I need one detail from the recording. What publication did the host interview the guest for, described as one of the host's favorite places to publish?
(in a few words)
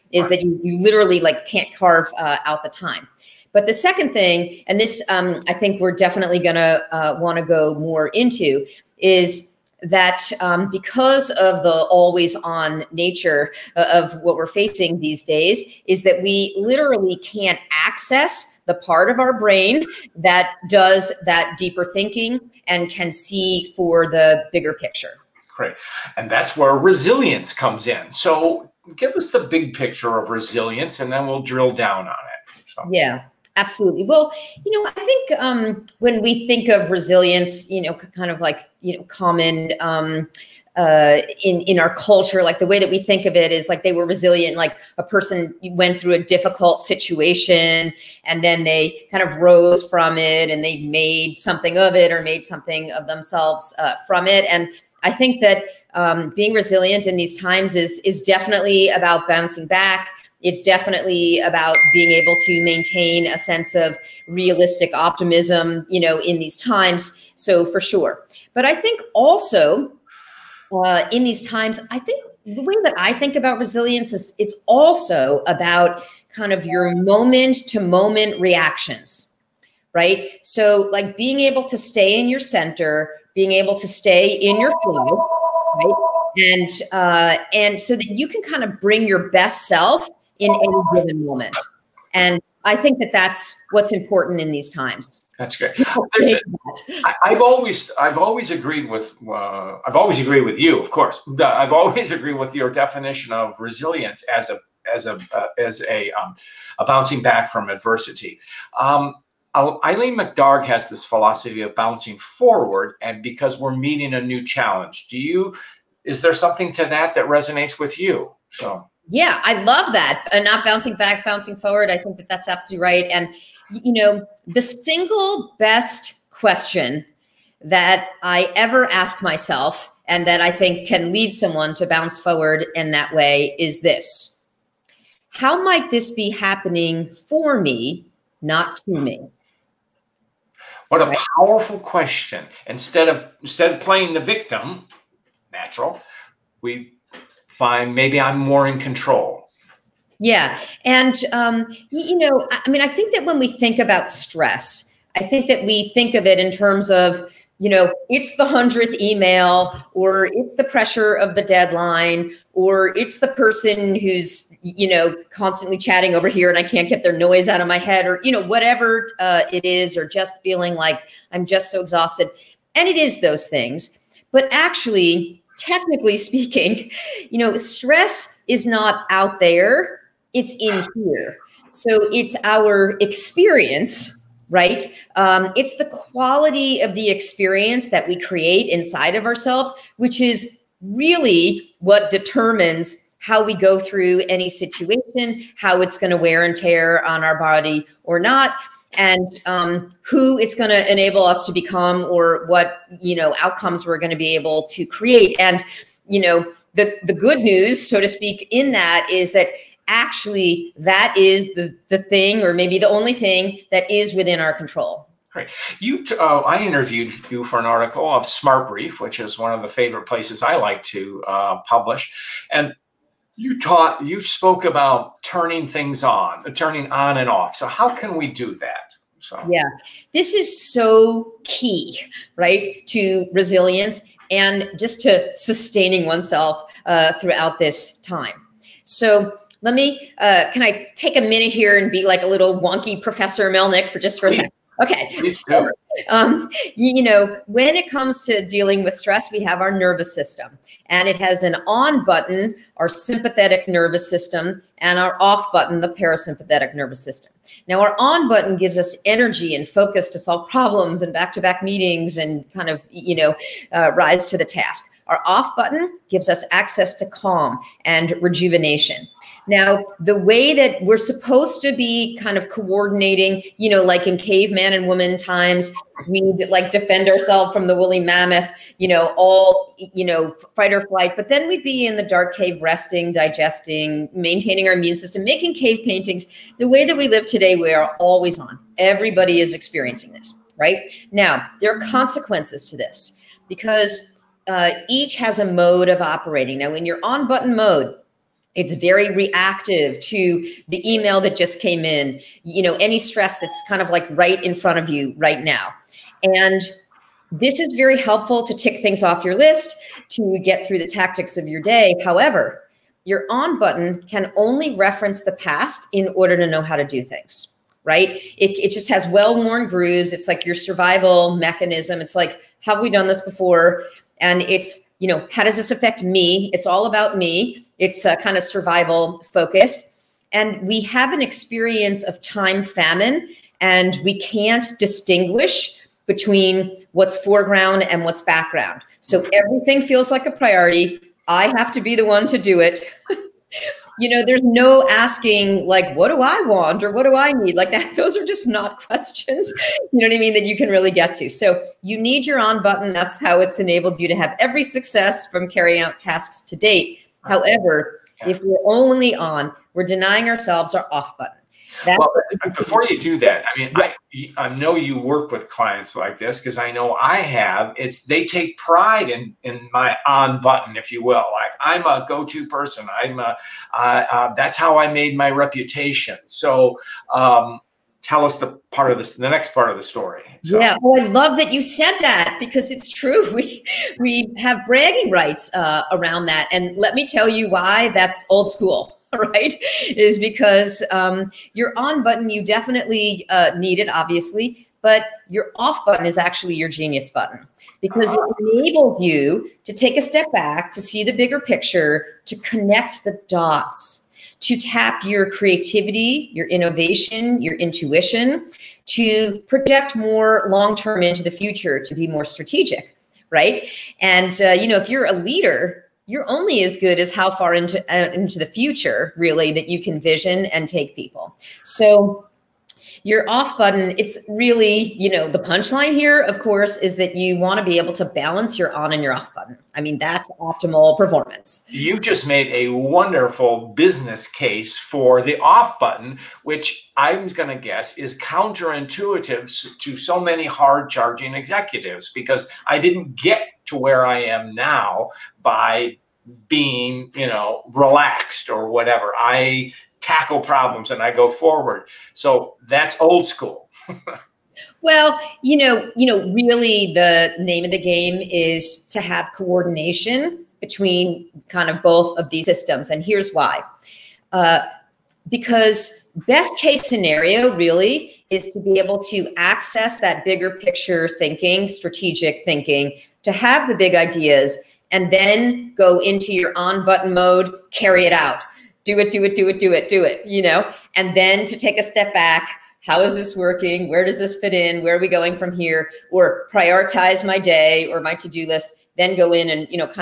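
Smart Brief.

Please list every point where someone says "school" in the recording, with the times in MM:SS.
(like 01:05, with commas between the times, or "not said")
06:28, 07:33.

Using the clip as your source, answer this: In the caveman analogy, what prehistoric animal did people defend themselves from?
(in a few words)
woolly mammoth.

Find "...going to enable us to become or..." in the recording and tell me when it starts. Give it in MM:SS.
03:20.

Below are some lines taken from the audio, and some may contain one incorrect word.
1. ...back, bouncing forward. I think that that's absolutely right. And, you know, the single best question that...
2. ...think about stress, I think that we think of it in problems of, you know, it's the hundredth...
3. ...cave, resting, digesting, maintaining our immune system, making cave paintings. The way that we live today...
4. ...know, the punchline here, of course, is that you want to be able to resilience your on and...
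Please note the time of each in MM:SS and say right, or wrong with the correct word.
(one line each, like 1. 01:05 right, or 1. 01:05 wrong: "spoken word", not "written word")
1. 02:00 right
2. 02:33 wrong: "terms", not "problems"
3. 04:42 right
4. 07:05 wrong: "balance", not "resilience".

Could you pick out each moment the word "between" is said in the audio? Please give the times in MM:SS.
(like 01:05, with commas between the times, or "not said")
05:36, 07:40.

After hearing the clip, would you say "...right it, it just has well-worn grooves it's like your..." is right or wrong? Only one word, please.
right.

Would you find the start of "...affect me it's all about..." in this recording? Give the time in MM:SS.
05:25.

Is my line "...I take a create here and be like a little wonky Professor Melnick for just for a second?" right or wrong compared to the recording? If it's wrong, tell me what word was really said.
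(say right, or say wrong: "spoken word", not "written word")
wrong: "minute", not "create".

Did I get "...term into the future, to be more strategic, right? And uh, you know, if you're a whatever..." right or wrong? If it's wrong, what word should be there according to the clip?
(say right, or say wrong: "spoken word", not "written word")
wrong: "leader", not "whatever".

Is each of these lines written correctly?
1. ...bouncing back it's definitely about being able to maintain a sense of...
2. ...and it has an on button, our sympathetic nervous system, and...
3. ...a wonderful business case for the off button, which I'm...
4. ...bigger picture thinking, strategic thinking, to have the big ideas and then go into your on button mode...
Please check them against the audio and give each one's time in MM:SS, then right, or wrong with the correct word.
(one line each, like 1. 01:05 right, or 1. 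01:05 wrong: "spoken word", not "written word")
1. 00:59 right
2. 04:10 right
3. 07:12 right
4. 07:50 right.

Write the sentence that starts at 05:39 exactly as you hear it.
So everything feels like a priority.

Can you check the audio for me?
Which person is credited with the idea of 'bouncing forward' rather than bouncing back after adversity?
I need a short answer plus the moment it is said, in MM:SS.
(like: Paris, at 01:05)
Eileen McDargh, at 01:49.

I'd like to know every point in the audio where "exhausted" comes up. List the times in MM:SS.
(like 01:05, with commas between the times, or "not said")
02:51.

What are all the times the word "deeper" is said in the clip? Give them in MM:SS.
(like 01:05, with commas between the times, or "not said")
00:21.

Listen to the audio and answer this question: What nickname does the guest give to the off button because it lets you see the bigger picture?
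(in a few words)
genius button.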